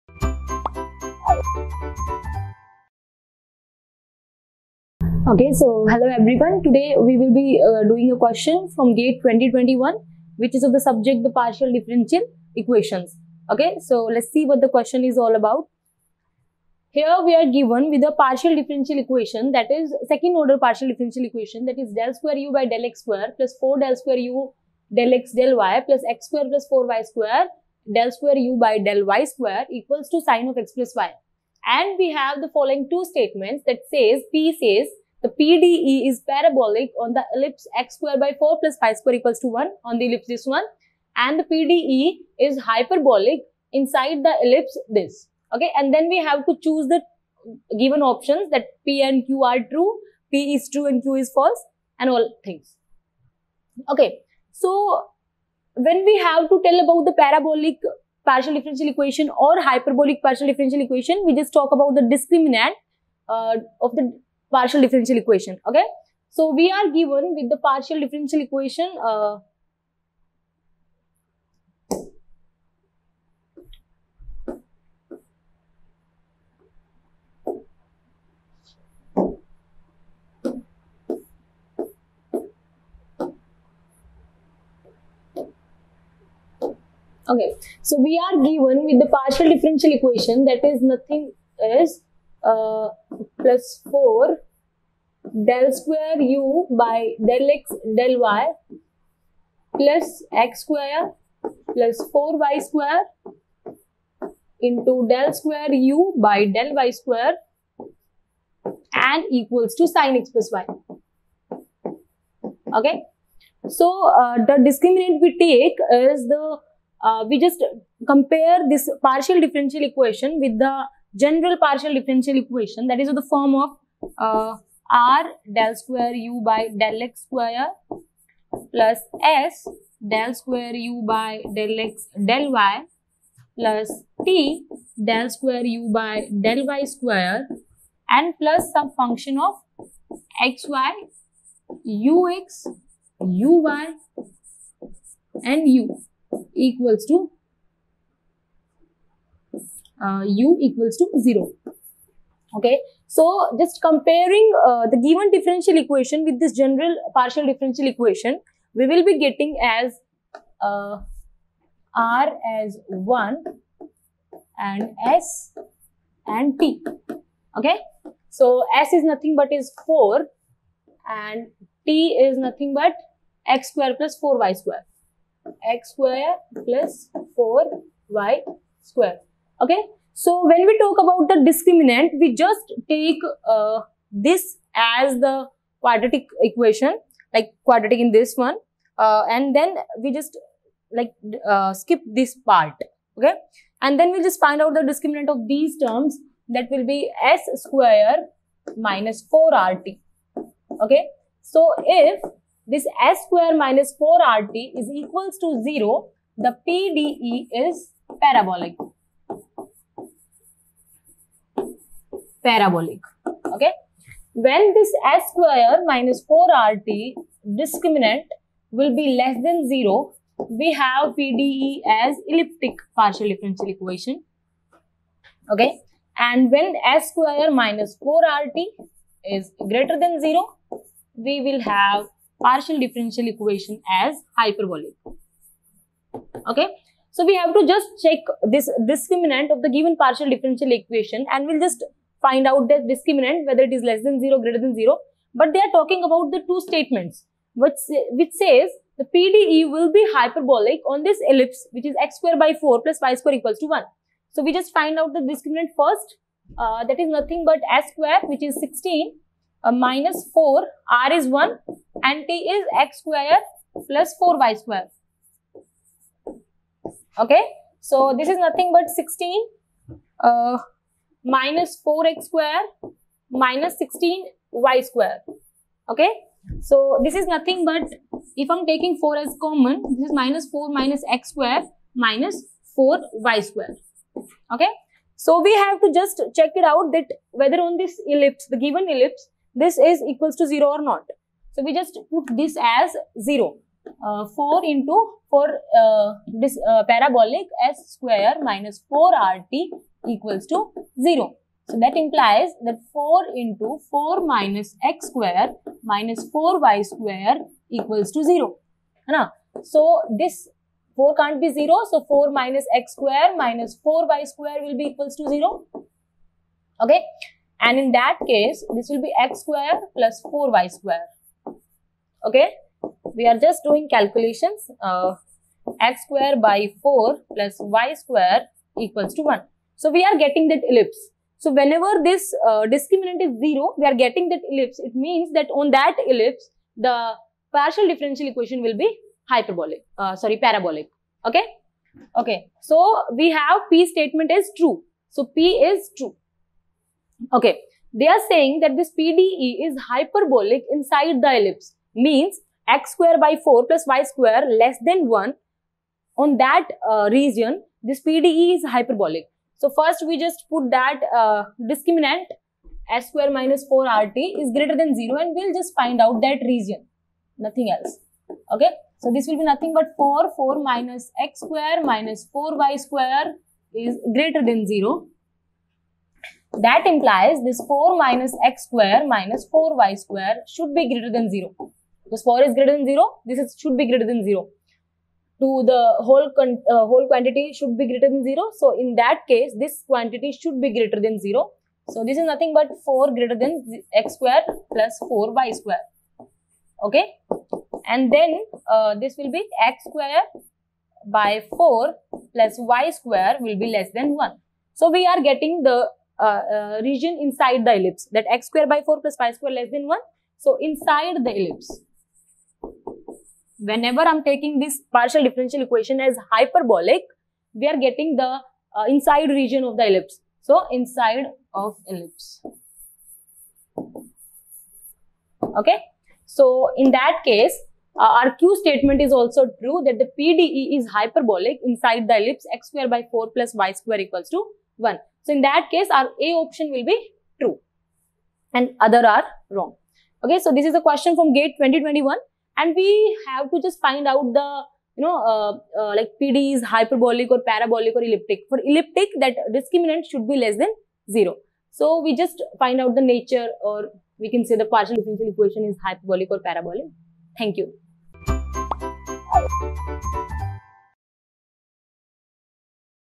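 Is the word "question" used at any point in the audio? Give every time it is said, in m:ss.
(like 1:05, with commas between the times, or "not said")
0:08, 0:14, 7:20.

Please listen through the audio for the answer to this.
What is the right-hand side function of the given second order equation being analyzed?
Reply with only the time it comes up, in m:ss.
0:30.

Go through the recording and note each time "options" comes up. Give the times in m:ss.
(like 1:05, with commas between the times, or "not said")
0:48, 7:16.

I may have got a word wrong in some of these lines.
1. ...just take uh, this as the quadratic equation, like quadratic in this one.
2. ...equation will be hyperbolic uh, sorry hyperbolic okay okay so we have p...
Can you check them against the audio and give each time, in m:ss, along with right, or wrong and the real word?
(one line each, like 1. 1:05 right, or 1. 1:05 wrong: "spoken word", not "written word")
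1. 3:02 right
2. 5:38 wrong: "parabolic", not "hyperbolic".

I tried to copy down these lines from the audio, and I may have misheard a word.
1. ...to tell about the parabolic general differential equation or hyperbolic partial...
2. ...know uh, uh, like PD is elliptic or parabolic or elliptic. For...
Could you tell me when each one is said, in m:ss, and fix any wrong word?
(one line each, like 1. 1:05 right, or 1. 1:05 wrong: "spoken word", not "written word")
1. 0:56 wrong: "partial", not "general"
2. 7:25 wrong: "hyperbolic", not "elliptic".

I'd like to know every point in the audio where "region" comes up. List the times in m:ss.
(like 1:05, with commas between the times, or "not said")
5:57, 6:06, 6:46, 6:59.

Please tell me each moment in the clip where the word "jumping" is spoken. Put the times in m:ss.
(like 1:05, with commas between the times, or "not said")
not said.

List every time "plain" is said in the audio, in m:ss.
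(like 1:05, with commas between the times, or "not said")
not said.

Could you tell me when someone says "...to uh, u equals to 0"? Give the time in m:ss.
2:27.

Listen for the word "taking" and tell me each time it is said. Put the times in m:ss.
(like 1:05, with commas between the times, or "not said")
4:38, 6:54.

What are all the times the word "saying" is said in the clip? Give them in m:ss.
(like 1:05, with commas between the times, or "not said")
5:48.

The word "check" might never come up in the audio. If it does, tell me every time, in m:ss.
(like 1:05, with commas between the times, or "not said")
3:58, 4:46.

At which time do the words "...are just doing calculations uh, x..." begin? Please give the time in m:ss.
5:23.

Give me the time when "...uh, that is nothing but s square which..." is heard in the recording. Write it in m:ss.
4:16.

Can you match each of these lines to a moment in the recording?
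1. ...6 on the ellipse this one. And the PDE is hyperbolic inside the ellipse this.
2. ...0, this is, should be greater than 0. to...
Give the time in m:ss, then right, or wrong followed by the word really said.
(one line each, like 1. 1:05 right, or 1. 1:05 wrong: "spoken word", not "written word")
1. 0:39 wrong: "1", not "6"
2. 6:22 right.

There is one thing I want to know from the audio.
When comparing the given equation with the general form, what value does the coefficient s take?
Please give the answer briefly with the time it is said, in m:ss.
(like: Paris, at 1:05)
4, at 2:48.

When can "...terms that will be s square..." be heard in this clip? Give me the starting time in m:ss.
3:15.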